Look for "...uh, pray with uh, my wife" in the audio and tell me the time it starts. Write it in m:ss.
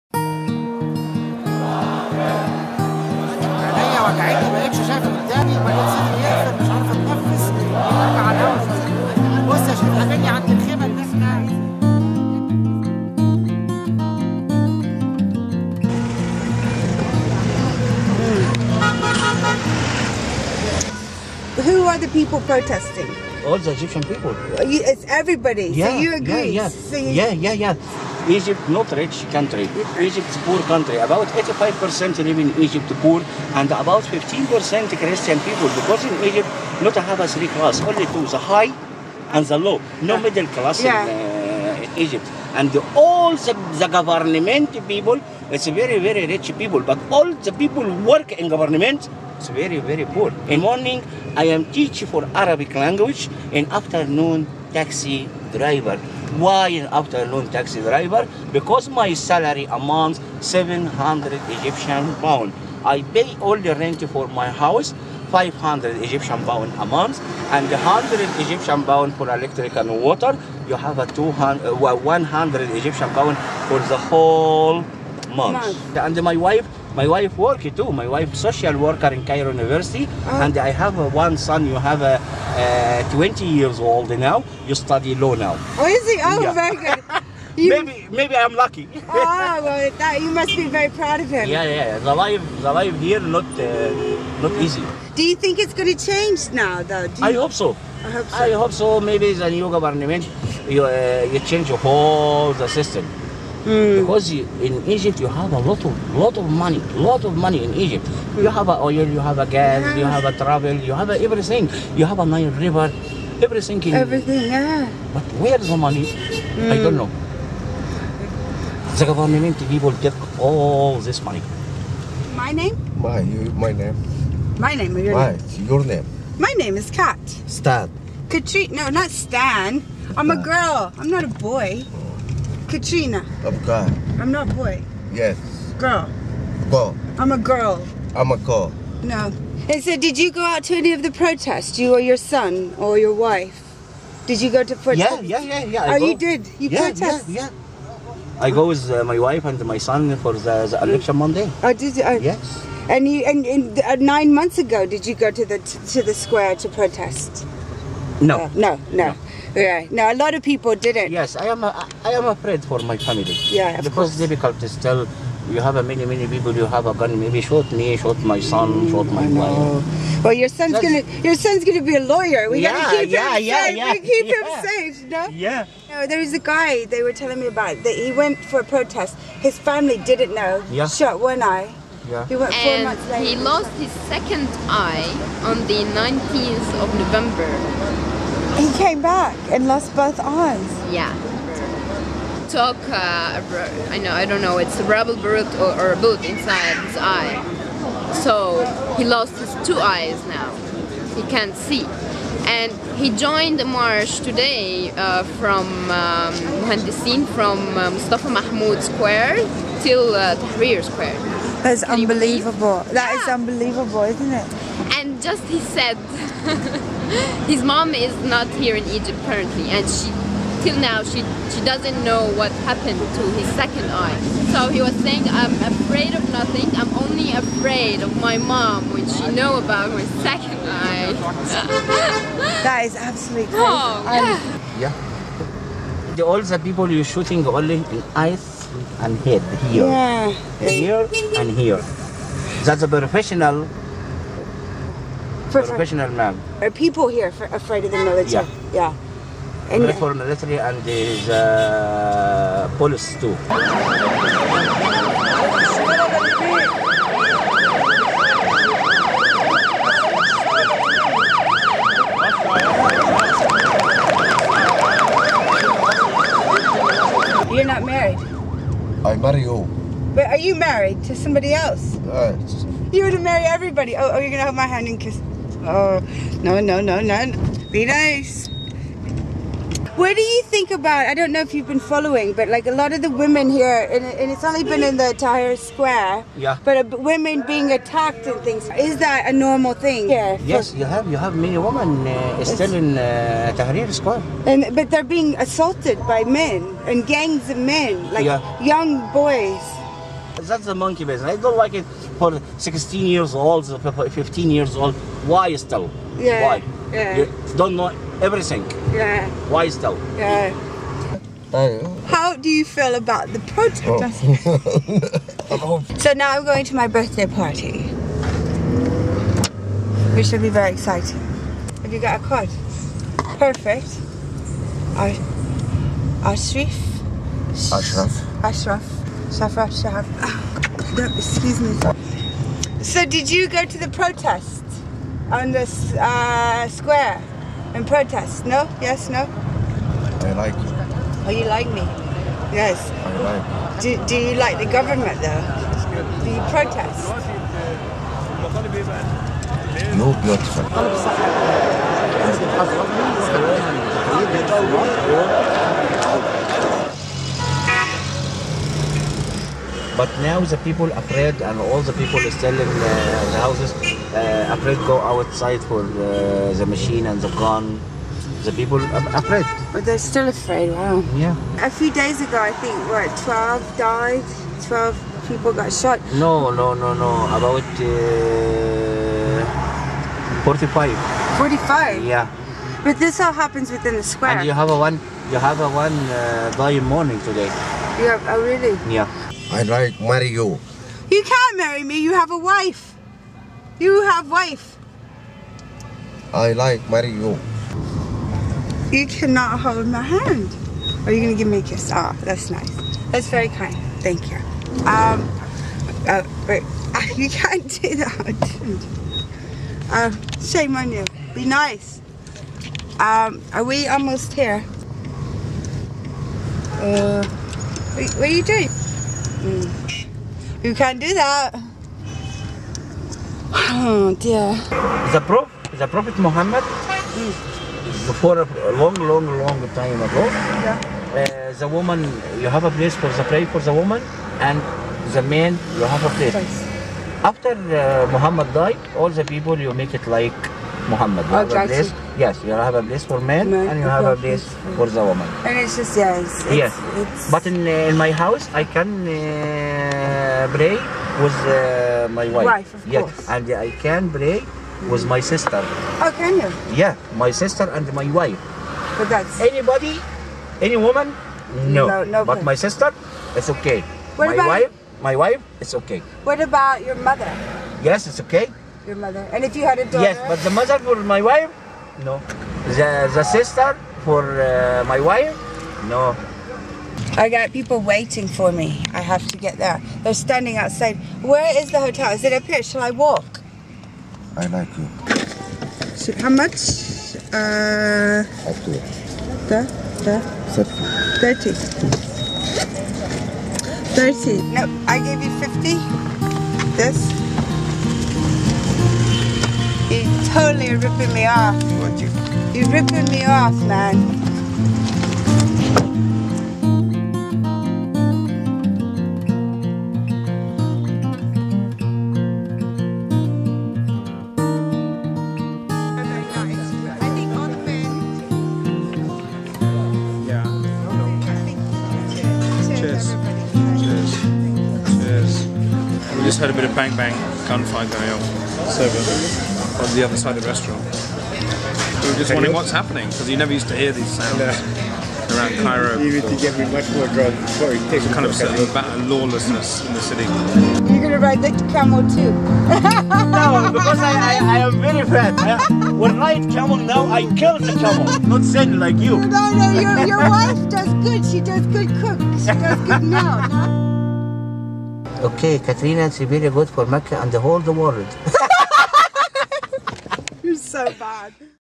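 7:29.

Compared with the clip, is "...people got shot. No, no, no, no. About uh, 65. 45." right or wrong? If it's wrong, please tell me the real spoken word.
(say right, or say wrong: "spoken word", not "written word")
wrong: "45", not "65".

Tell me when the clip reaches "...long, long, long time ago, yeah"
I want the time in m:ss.
7:08.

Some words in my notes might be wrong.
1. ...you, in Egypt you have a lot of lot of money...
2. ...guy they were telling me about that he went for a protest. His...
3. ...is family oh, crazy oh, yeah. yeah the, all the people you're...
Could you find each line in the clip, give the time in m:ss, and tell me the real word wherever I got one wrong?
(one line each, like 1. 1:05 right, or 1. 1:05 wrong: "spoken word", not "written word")
1. 1:44 right
2. 2:56 right
3. 3:52 wrong: "absolutely", not "family".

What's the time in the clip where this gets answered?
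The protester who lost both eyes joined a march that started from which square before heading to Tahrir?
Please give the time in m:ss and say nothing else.
3:27.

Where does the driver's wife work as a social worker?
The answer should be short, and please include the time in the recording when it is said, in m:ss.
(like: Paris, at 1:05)
Cairo University, at 1:19.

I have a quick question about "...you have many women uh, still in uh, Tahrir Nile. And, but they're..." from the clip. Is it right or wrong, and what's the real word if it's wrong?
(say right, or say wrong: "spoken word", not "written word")
wrong: "Square", not "Nile".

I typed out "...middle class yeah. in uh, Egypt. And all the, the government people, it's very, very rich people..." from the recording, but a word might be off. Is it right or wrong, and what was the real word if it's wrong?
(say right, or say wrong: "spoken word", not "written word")
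right.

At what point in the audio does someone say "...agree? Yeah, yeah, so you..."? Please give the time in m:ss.
0:26.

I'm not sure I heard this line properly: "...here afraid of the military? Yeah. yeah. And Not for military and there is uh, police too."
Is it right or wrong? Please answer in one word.
right.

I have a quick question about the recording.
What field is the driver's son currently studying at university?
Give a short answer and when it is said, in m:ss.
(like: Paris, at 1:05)
Law, at 1:25.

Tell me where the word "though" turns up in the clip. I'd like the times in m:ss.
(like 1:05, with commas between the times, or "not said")
1:36, 5:45.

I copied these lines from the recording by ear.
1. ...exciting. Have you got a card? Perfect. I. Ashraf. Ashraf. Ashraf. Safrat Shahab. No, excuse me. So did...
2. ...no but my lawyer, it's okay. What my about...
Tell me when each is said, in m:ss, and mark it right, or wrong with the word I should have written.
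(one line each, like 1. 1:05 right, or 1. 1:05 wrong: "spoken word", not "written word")
1. 5:20 right
2. 7:42 wrong: "sister", not "lawyer".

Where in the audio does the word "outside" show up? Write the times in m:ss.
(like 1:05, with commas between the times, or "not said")
6:04, 8:00.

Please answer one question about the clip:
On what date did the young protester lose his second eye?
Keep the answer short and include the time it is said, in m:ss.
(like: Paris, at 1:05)
19th of November, at 3:05.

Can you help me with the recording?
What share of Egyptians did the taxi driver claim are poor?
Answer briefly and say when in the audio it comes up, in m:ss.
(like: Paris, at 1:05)
85%, at 0:31.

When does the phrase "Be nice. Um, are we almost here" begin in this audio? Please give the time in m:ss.
6:51.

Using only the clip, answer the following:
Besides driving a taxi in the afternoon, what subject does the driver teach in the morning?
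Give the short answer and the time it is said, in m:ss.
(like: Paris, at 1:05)
Arabic language, at 0:52.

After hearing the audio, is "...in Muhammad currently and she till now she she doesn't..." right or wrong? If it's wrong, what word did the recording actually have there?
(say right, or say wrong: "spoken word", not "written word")
wrong: "Egypt", not "Muhammad".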